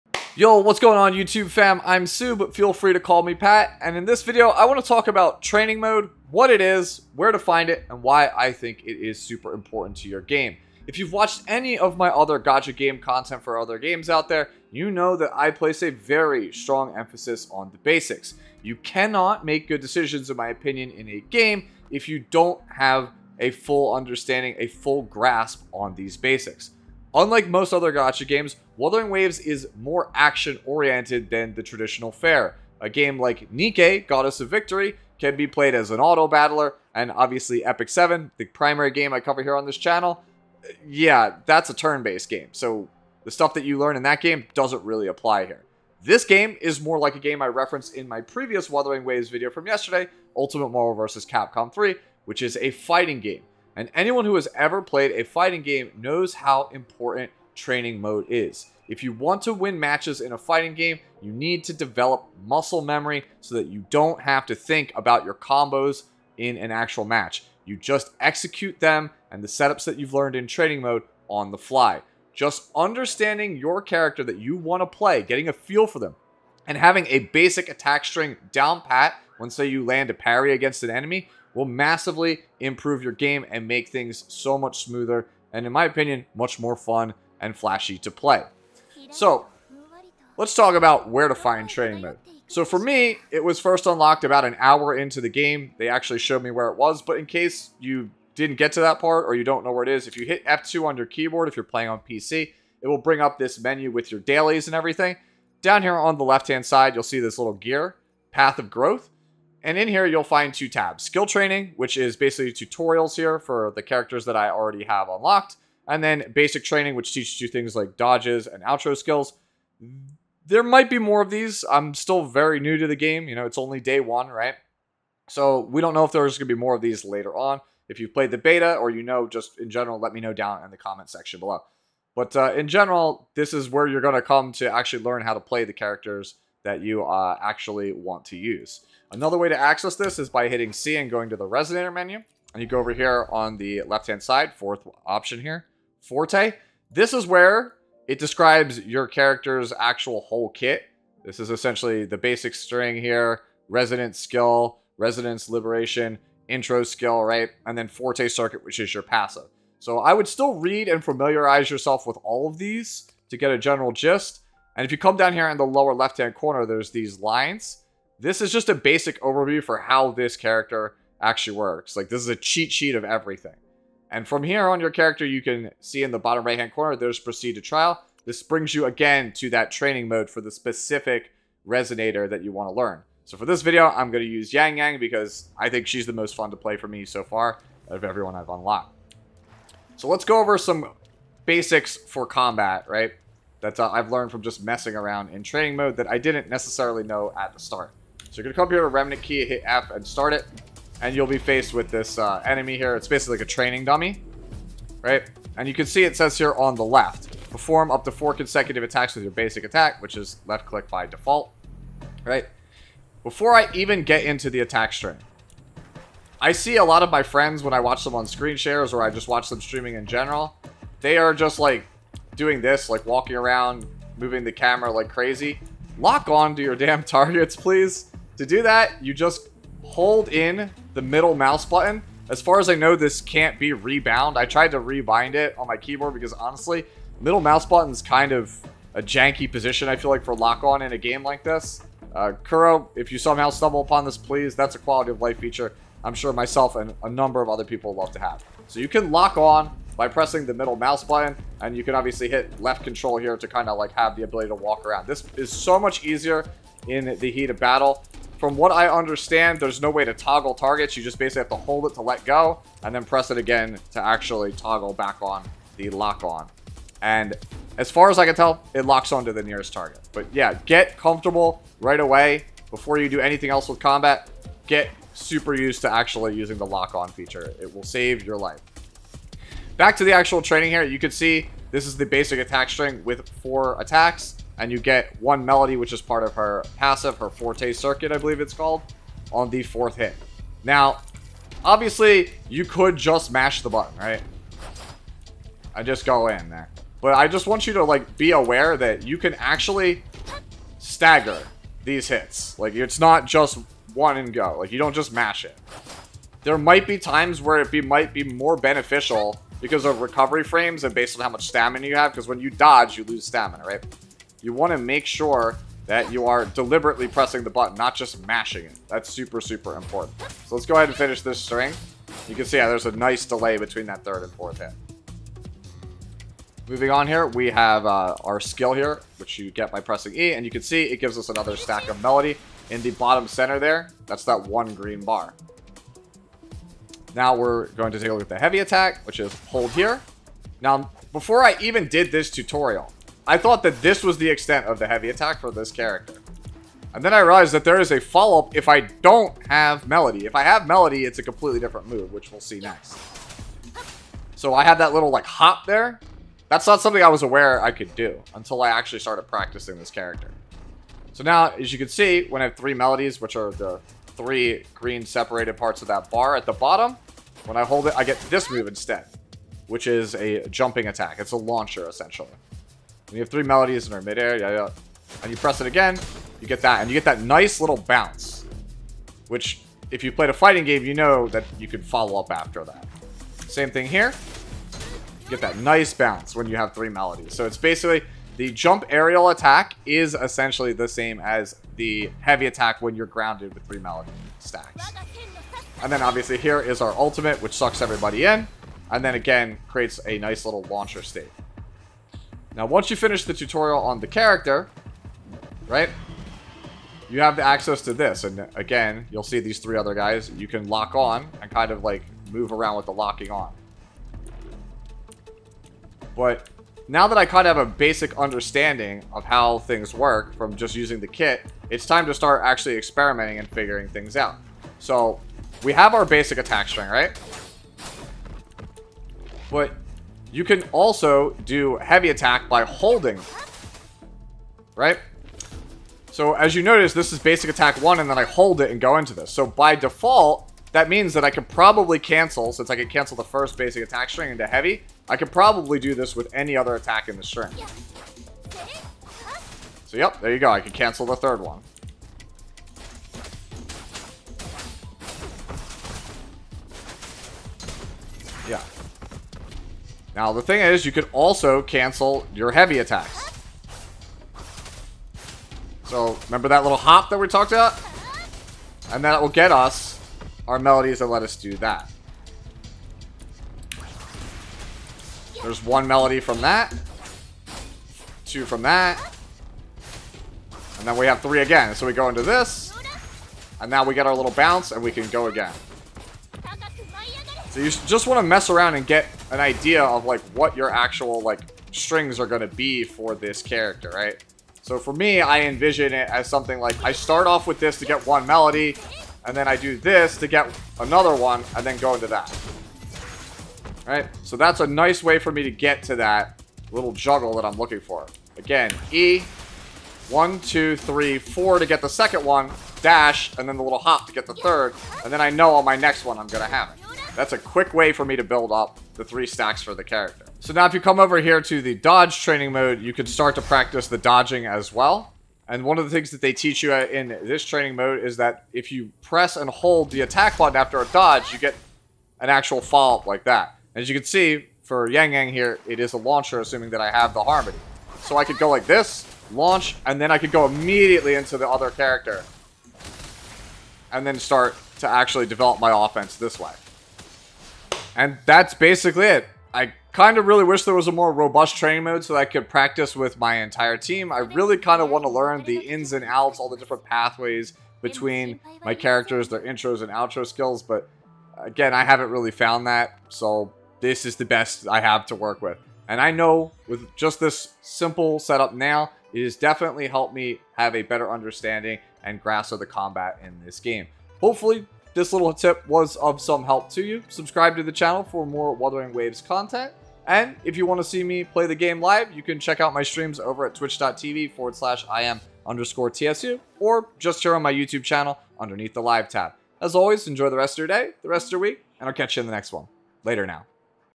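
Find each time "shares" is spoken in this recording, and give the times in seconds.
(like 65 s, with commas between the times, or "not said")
218 s.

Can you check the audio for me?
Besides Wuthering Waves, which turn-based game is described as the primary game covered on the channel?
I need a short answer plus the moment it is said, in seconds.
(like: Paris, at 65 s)
Epic 7, at 37 s.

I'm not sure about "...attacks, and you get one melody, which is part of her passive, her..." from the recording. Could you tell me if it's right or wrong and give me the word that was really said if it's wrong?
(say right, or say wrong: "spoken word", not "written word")
right.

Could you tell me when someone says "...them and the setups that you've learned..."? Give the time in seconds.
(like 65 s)
68 s.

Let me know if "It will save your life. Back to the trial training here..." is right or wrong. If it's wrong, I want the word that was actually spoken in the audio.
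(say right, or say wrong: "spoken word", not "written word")
wrong: "actual", not "trial".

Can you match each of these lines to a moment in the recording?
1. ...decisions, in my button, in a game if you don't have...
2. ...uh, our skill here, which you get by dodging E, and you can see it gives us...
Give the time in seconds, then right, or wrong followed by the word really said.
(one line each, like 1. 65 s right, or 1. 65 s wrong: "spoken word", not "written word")
1. 19 s wrong: "opinion", not "button"
2. 327 s wrong: "pressing", not "dodging".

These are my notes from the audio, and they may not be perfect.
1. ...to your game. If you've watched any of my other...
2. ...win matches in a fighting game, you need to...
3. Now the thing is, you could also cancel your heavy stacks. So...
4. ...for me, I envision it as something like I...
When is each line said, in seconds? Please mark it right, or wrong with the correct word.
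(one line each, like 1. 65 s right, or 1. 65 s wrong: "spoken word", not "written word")
1. 9 s right
2. 59 s right
3. 460 s wrong: "attacks", not "stacks"
4. 494 s right.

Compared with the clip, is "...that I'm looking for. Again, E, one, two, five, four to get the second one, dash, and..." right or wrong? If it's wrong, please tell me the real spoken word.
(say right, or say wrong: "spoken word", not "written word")
wrong: "three", not "five".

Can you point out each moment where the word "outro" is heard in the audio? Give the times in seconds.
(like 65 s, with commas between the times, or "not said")
118 s, 559 s.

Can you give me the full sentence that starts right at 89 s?
So, let's talk about where to find training mode.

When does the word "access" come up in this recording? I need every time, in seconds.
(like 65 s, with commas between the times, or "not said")
139 s, 407 s.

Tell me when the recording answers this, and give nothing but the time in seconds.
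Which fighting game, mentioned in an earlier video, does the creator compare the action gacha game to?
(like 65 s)
50 s.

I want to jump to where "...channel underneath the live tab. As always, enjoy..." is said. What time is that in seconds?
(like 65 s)
587 s.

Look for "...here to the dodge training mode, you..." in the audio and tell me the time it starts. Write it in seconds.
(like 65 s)
521 s.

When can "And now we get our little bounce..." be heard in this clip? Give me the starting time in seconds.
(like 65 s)
483 s.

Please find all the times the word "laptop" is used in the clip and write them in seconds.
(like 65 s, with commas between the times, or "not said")
not said.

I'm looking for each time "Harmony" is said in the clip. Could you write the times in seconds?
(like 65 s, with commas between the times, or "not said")
537 s.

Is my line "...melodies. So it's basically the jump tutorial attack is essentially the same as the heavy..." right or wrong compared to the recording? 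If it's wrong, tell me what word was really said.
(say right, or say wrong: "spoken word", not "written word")
wrong: "aerial", not "tutorial".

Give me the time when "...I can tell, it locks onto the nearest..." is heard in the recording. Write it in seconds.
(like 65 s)
268 s.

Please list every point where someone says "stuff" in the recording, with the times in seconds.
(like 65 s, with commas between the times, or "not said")
43 s.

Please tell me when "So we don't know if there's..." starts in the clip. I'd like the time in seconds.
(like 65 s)
125 s.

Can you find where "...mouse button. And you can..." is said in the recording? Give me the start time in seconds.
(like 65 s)
250 s.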